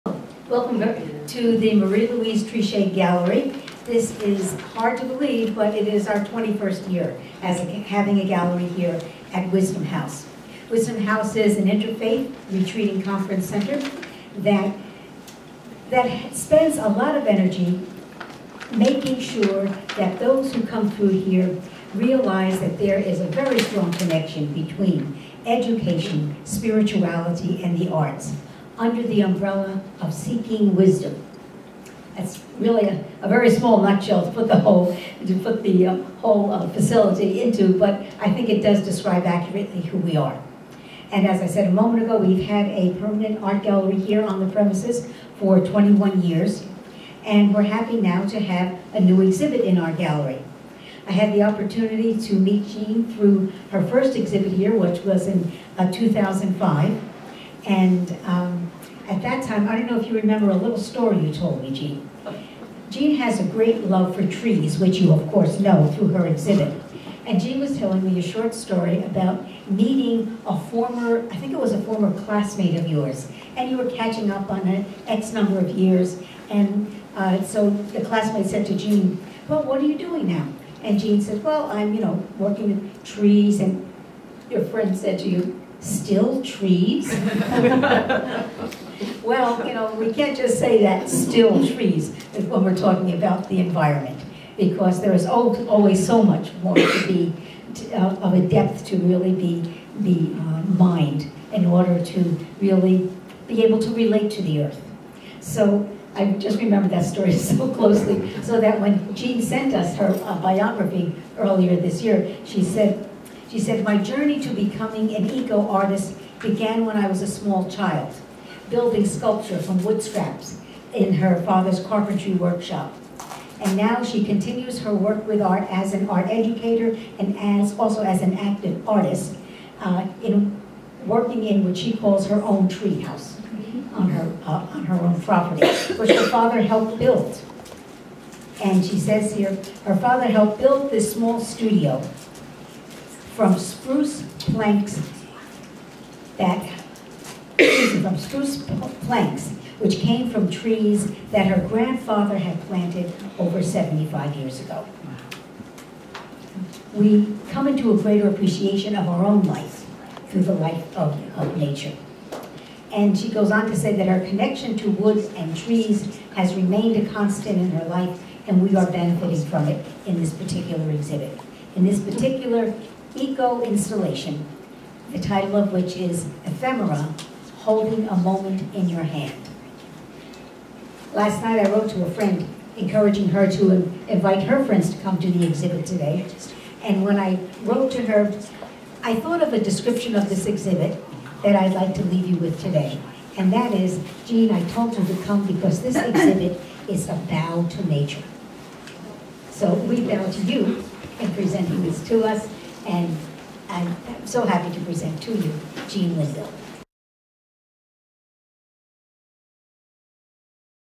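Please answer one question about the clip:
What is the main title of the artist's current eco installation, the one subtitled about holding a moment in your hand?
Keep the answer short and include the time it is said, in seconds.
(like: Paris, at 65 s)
Ephemera, at 176 s.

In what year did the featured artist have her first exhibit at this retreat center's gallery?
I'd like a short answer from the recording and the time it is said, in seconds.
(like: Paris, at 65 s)
2005, at 55 s.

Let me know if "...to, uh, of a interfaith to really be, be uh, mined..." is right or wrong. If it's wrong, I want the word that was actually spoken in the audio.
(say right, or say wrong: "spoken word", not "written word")
wrong: "depth", not "interfaith".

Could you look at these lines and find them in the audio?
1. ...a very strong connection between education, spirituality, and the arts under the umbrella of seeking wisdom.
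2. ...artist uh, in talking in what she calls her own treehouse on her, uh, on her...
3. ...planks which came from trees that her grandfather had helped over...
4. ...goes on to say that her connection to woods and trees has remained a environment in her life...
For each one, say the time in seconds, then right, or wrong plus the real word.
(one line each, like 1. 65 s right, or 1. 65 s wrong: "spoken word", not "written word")
1. 23 s right
2. 128 s wrong: "working", not "talking"
3. 149 s wrong: "planted", not "helped"
4. 163 s wrong: "constant", not "environment".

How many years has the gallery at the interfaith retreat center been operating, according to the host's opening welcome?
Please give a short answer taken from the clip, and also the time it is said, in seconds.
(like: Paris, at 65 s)
21, at 6 s.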